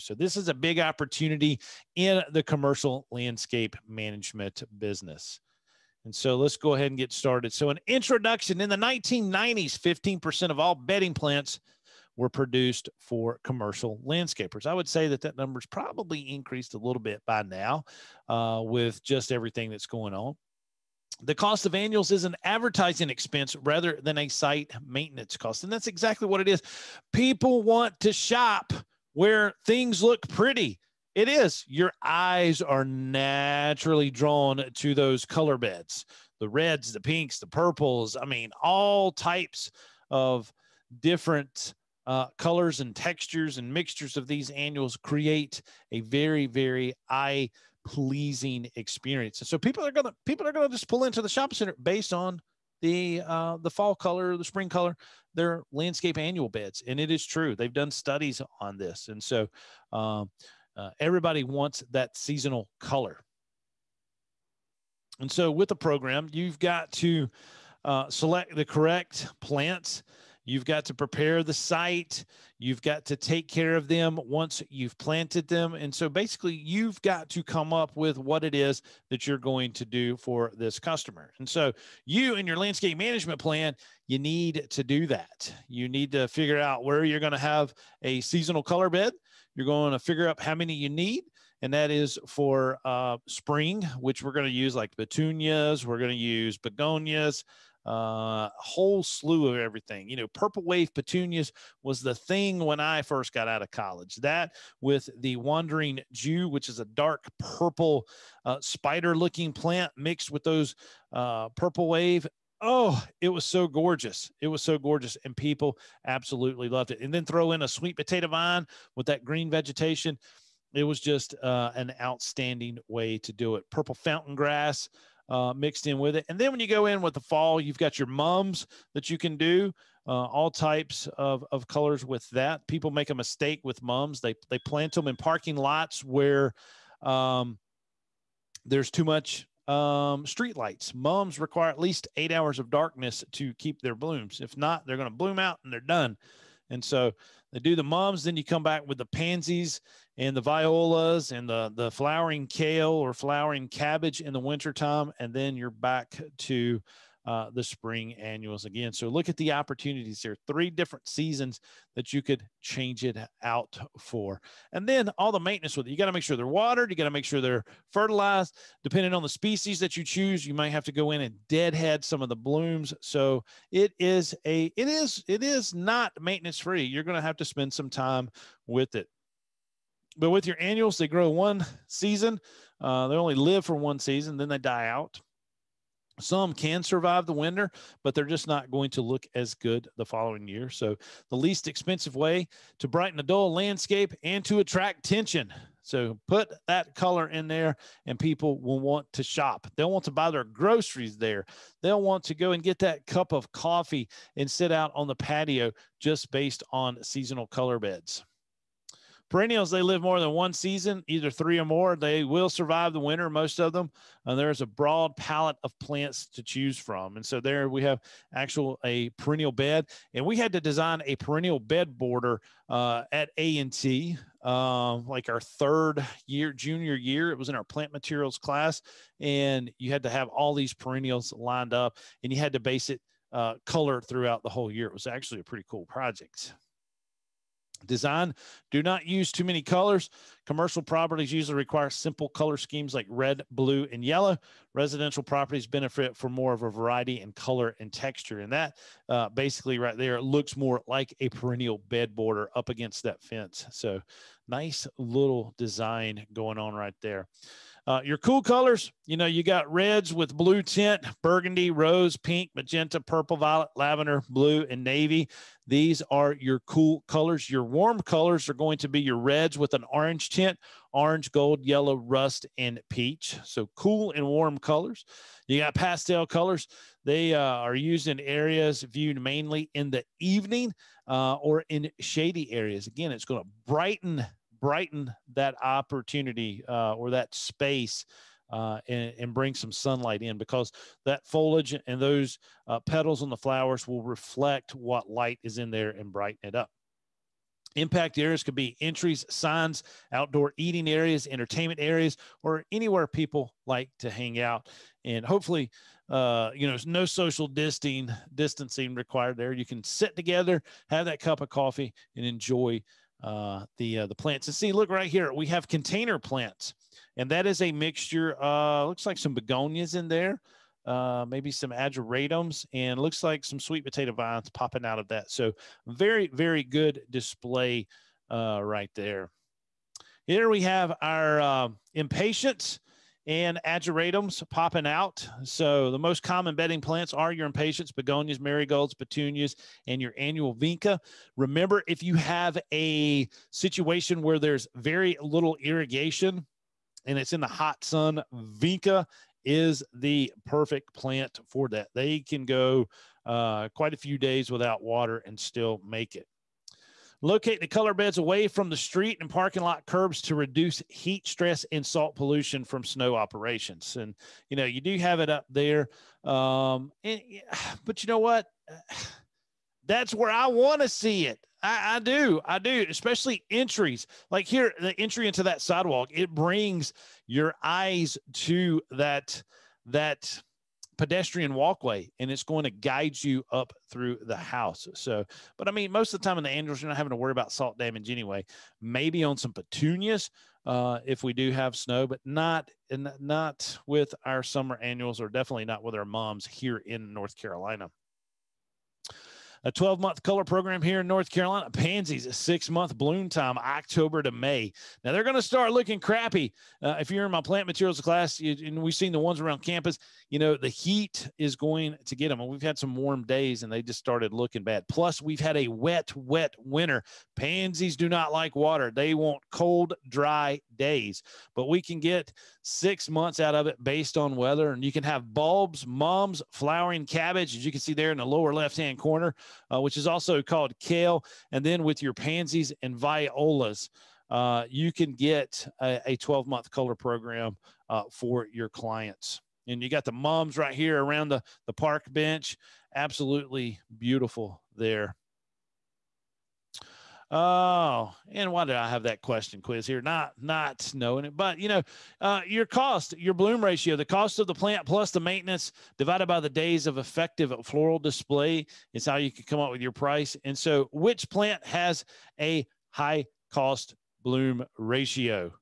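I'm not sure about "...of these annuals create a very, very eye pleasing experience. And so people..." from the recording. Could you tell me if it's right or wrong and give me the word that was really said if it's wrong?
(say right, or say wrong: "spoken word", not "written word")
right.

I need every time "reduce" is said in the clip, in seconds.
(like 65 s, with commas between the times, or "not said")
360 s.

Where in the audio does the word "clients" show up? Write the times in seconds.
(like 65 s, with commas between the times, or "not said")
438 s.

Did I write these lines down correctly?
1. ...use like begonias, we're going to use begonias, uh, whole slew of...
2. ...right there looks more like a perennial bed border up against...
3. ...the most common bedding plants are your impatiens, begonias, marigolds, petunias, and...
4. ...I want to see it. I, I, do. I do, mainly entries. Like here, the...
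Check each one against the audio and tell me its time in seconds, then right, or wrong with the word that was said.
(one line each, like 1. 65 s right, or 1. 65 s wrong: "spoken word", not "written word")
1. 94 s wrong: "petunias", not "begonias"
2. 249 s right
3. 335 s right
4. 370 s wrong: "especially", not "mainly".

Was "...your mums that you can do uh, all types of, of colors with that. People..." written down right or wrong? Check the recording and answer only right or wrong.
right.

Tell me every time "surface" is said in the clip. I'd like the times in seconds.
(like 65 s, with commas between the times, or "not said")
not said.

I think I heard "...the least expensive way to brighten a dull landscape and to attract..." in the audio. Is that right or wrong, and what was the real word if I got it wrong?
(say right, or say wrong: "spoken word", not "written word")
right.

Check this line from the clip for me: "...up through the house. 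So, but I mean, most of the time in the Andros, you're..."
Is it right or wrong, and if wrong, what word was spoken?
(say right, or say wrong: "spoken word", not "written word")
right.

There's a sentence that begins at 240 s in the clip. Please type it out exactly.
Commercial properties usually require simple color schemes like red, blue, and yellow.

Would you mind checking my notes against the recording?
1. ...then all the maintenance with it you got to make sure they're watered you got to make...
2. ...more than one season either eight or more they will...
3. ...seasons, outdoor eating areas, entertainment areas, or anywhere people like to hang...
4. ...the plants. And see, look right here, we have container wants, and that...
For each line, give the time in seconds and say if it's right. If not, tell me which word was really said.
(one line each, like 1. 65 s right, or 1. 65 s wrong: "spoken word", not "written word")
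1. 164 s right
2. 210 s wrong: "three", not "eight"
3. 299 s wrong: "signs", not "seasons"
4. 314 s wrong: "plants", not "wants".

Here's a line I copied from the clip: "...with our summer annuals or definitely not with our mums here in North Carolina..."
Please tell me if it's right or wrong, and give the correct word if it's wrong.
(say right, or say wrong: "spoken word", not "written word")
right.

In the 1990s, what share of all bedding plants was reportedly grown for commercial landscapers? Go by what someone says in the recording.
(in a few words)
15%.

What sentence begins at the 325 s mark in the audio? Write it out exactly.
So very very good display uh, right there.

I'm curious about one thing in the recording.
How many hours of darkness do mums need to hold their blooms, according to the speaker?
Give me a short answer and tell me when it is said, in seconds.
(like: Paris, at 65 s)
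8, at 142 s.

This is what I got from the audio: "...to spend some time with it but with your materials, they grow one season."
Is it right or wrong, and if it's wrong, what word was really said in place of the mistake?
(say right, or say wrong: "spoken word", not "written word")
wrong: "annuals", not "materials".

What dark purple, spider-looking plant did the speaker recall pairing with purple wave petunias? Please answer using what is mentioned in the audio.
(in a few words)
wandering Jew.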